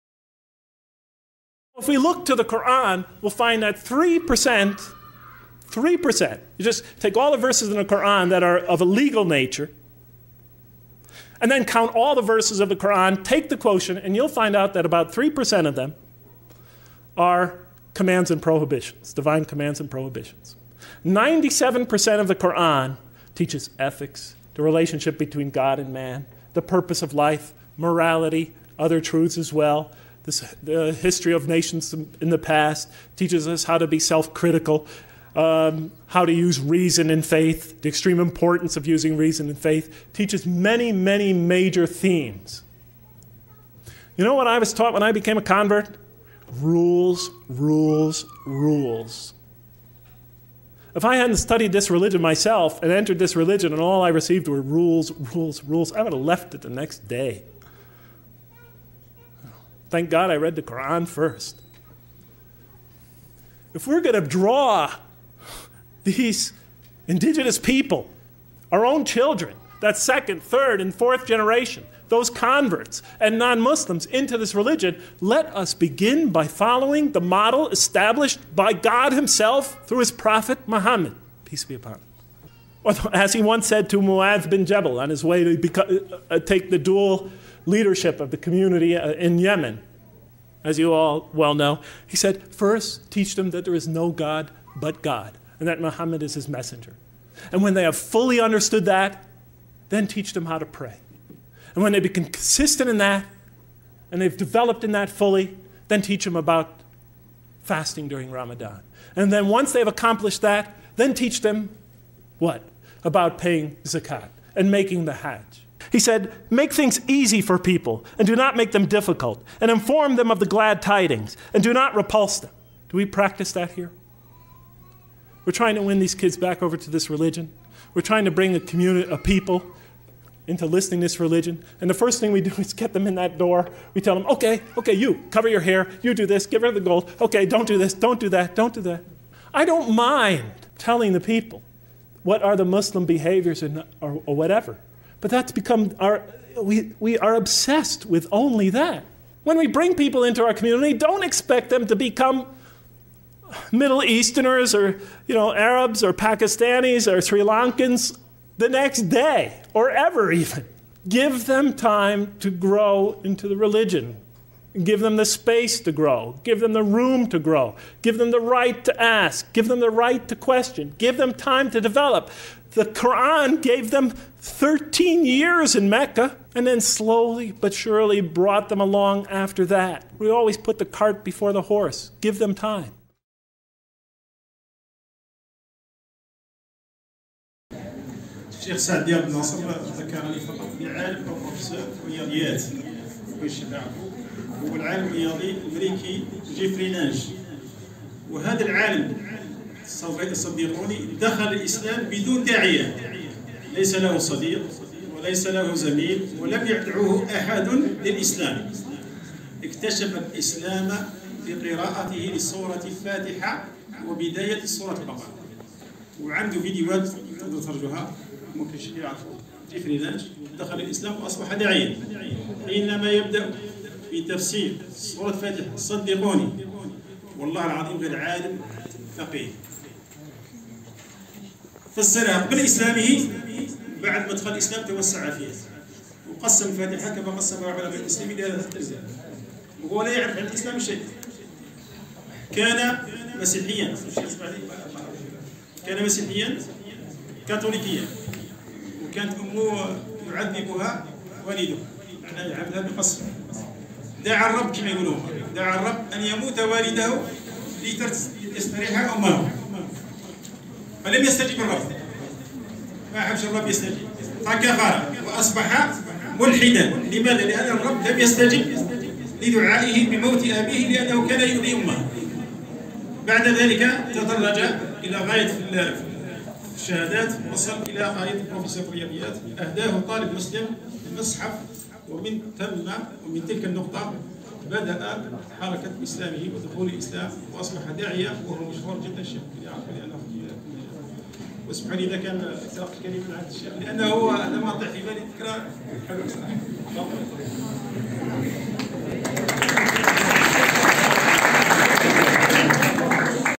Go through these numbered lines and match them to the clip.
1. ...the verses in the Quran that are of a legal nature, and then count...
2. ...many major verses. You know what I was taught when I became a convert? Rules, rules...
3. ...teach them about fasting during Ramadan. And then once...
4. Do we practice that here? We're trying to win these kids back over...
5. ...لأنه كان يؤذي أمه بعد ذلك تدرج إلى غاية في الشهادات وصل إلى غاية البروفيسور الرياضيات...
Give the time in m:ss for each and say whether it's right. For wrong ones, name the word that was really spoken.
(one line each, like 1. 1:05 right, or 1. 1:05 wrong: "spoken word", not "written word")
1. 0:07 right
2. 0:40 wrong: "themes", not "verses"
3. 1:46 right
4. 2:02 right
5. 4:30 right.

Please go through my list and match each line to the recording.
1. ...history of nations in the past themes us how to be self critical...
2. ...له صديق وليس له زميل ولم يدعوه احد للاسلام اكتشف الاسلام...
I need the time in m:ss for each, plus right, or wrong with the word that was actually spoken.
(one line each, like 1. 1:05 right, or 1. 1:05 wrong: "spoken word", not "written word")
1. 0:30 wrong: "teaches", not "themes"
2. 3:23 right.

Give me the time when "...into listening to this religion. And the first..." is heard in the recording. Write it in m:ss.
2:10.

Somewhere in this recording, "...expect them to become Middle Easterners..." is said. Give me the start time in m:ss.
2:31.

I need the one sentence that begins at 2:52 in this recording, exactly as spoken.
The Quran gave them 13 years in Mecca and then slowly but surely brought them along after that.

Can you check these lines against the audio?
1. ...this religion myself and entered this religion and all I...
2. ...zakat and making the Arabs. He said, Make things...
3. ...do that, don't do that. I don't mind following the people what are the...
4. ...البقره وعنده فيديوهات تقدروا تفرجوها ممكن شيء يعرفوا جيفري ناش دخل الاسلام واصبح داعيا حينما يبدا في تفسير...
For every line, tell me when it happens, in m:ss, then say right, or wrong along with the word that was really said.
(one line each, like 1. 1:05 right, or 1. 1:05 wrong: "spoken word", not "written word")
1. 0:51 right
2. 1:53 wrong: "Hajj", not "Arabs"
3. 2:18 wrong: "telling", not "following"
4. 3:34 right.